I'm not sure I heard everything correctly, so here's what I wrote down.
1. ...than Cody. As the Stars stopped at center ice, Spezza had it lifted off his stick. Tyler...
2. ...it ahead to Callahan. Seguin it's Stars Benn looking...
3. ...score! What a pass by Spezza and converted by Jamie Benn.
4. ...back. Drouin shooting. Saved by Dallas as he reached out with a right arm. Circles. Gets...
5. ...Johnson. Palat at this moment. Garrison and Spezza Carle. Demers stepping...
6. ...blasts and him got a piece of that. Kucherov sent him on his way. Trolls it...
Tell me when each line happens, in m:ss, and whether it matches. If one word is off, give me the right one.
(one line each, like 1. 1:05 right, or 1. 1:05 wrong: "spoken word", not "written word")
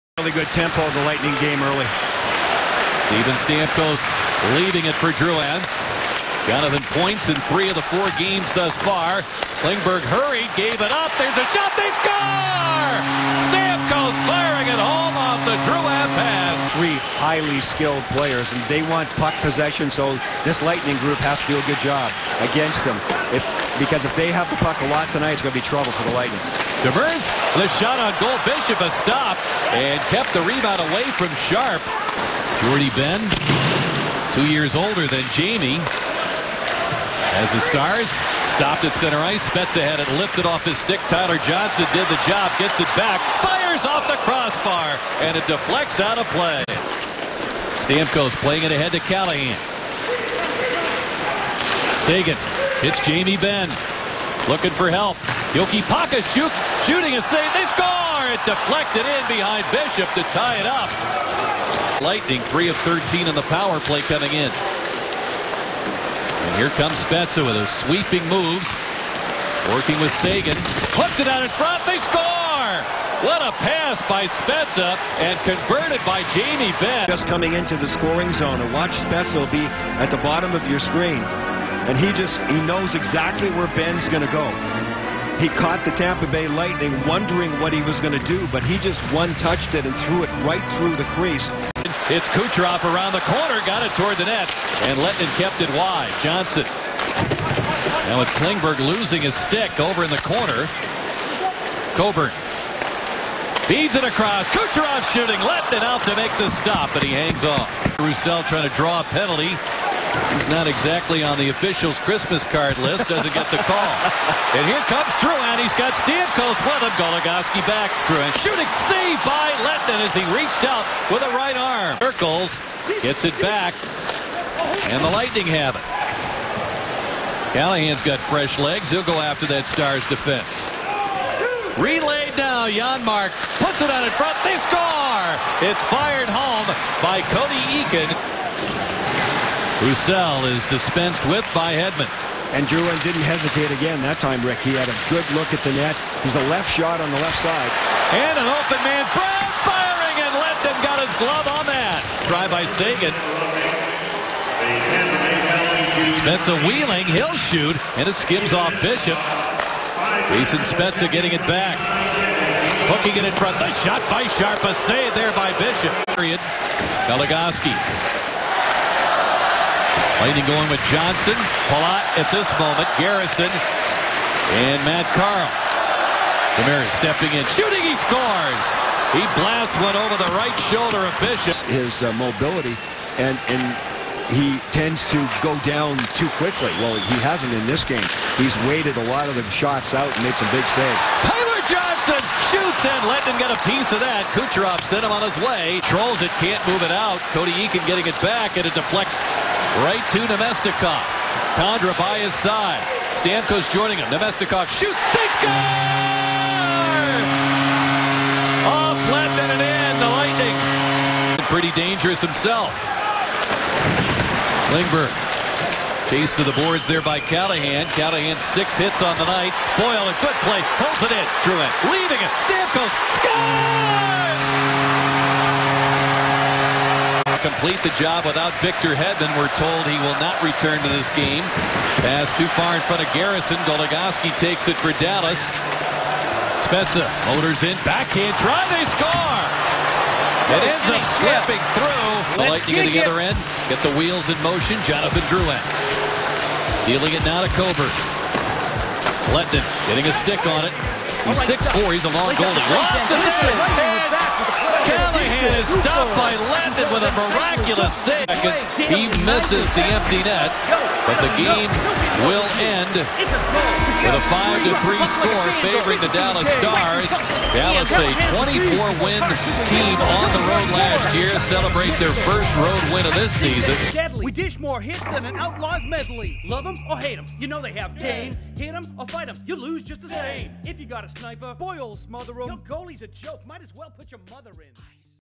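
1. 0:35 wrong: "Jamie", not "Cody"
2. 0:48 wrong: "Jamie", not "Stars"
3. 1:12 right
4. 1:57 wrong: "Lehtonen", not "Dallas"
5. 2:50 wrong: "Matt", not "Spezza"
6. 3:12 wrong: "shoots", not "blasts".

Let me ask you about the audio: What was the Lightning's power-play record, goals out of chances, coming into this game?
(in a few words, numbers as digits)
3 of 13.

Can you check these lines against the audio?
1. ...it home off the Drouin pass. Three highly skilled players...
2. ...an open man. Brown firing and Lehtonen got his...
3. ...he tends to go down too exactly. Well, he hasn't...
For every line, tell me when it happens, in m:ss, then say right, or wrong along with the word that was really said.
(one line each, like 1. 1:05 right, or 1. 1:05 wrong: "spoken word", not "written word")
1. 0:14 right
2. 2:28 right
3. 3:04 wrong: "quickly", not "exactly".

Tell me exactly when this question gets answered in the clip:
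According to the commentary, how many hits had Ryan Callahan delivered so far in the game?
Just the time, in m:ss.
3:38.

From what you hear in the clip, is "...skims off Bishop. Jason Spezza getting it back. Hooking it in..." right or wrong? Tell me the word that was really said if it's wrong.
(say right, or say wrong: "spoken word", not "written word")
right.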